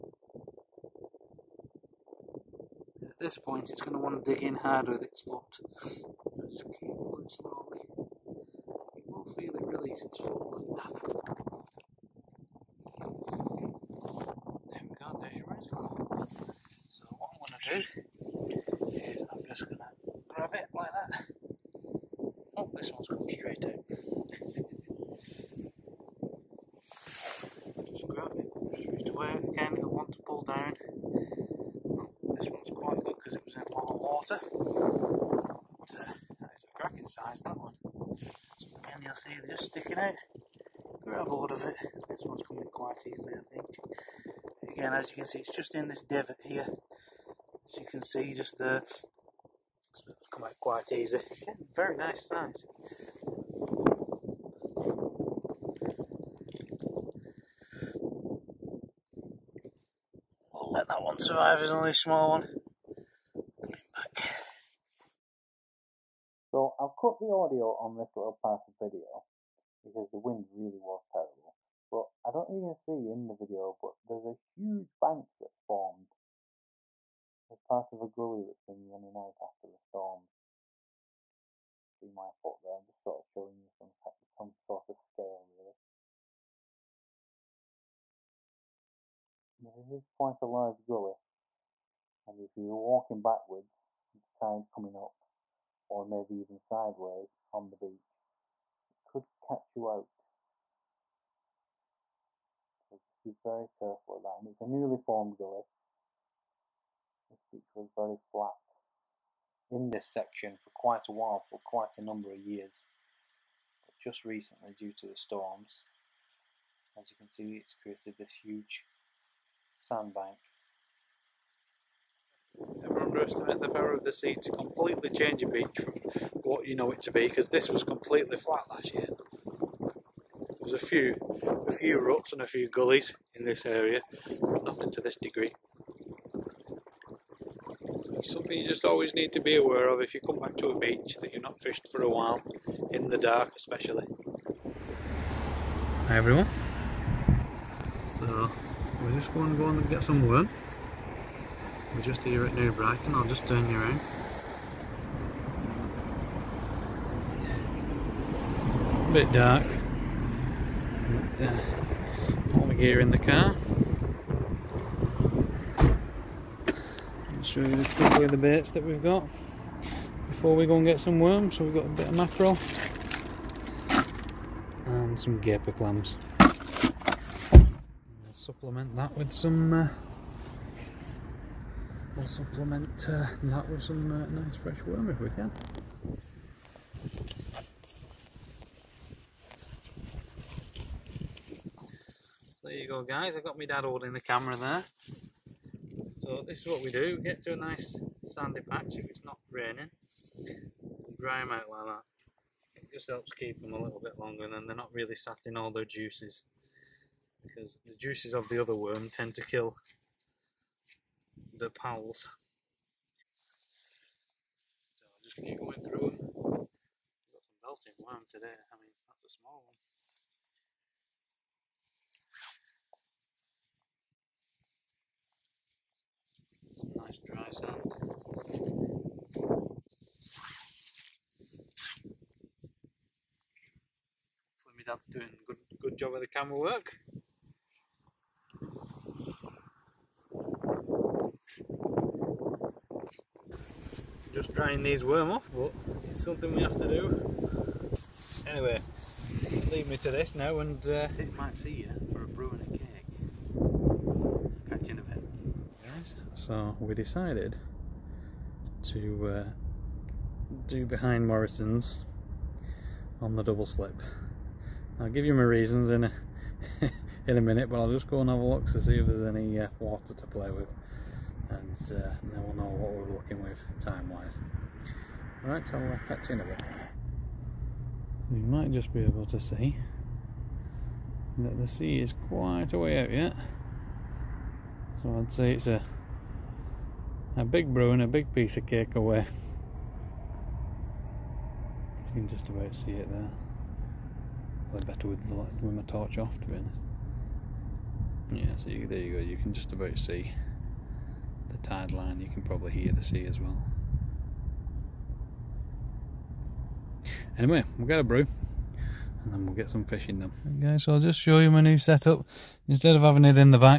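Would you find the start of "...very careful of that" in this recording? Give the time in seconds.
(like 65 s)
103 s.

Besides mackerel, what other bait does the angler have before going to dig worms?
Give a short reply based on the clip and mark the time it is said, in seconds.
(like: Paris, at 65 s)
Gaper clams, at 175 s.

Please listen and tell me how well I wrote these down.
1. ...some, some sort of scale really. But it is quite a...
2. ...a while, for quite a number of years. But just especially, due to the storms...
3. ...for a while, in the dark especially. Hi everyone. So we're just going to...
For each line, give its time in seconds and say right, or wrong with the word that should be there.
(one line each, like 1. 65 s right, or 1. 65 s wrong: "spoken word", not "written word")
1. 83 s right
2. 111 s wrong: "recently", not "especially"
3. 141 s right.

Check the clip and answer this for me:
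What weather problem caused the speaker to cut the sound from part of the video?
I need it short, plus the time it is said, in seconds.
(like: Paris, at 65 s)
The wind, at 70 s.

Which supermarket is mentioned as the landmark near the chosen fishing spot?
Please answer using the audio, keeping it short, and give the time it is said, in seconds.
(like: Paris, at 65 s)
Morrison's, at 261 s.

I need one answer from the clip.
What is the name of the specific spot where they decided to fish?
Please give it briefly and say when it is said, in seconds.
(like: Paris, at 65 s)
Double slip, at 263 s.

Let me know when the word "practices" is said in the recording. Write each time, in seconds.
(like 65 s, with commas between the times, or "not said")
not said.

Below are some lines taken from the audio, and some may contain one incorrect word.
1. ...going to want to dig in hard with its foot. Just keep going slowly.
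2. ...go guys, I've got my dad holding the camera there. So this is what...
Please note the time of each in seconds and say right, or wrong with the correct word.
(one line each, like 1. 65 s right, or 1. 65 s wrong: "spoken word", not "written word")
1. 3 s right
2. 192 s right.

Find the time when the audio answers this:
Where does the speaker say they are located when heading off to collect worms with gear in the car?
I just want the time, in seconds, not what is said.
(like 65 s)
152 s.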